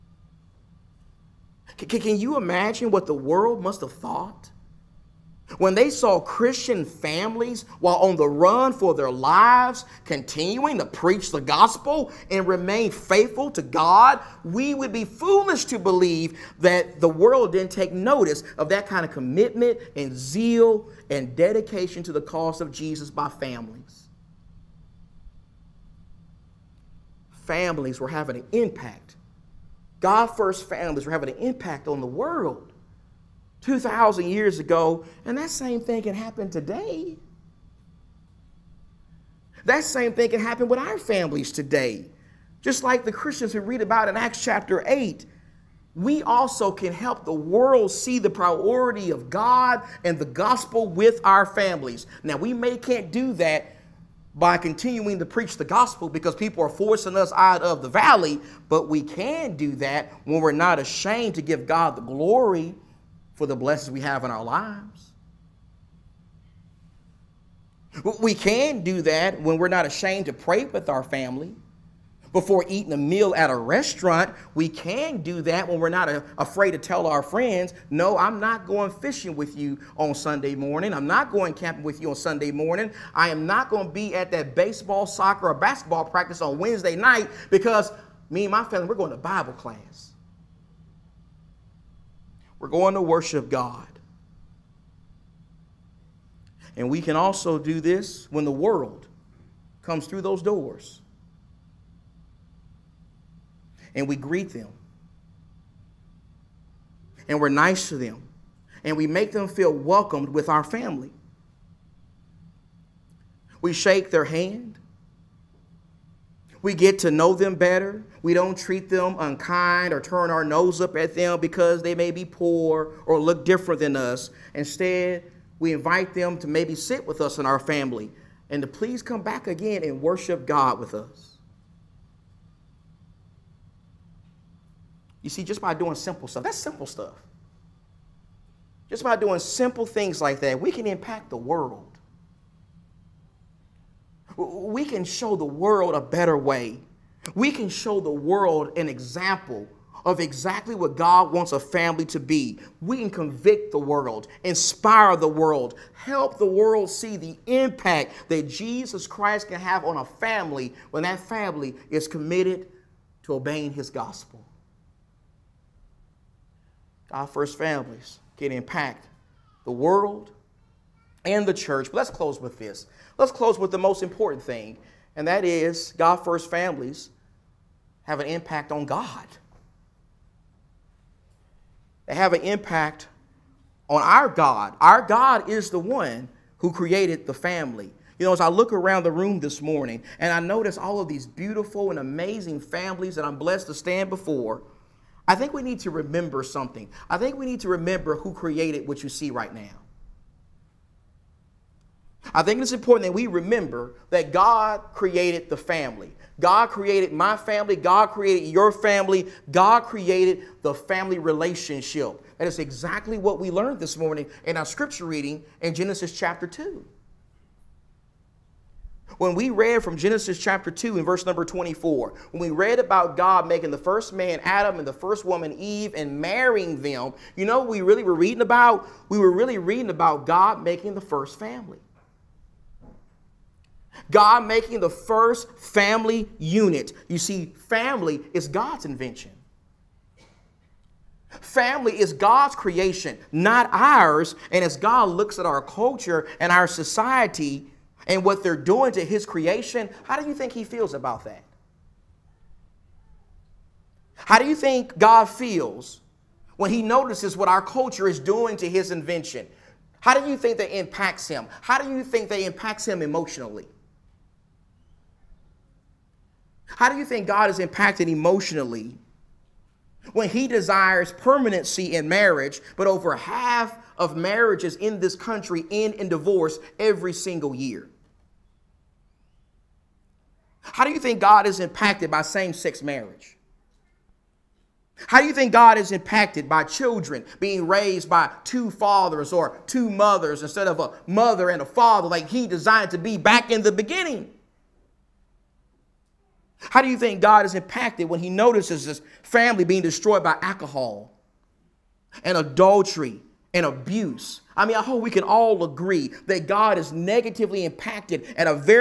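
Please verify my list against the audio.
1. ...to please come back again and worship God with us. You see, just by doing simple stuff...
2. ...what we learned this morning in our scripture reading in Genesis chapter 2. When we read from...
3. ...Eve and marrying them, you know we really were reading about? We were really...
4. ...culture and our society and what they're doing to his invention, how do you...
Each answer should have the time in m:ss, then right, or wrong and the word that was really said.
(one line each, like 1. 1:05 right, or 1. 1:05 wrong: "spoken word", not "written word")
1. 2:08 right
2. 3:33 right
3. 3:45 right
4. 4:05 wrong: "creation", not "invention".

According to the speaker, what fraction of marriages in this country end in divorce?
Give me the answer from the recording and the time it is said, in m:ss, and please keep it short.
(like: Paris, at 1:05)
over half, at 4:32.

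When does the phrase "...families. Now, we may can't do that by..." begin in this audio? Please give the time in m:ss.
0:51.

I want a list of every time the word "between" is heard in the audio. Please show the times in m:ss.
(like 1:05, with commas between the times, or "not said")
not said.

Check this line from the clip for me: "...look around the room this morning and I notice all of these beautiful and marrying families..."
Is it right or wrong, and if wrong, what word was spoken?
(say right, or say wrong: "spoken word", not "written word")
wrong: "amazing", not "marrying".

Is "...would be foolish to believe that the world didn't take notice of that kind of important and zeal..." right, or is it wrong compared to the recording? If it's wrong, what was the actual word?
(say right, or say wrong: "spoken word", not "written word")
wrong: "commitment", not "important".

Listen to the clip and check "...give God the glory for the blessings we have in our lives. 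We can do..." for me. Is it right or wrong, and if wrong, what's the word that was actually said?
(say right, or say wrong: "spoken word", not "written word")
right.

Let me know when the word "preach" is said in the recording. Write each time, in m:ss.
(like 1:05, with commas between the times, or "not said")
0:10, 0:55.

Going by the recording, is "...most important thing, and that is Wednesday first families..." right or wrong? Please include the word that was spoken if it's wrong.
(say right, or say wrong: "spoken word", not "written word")
wrong: "God", not "Wednesday".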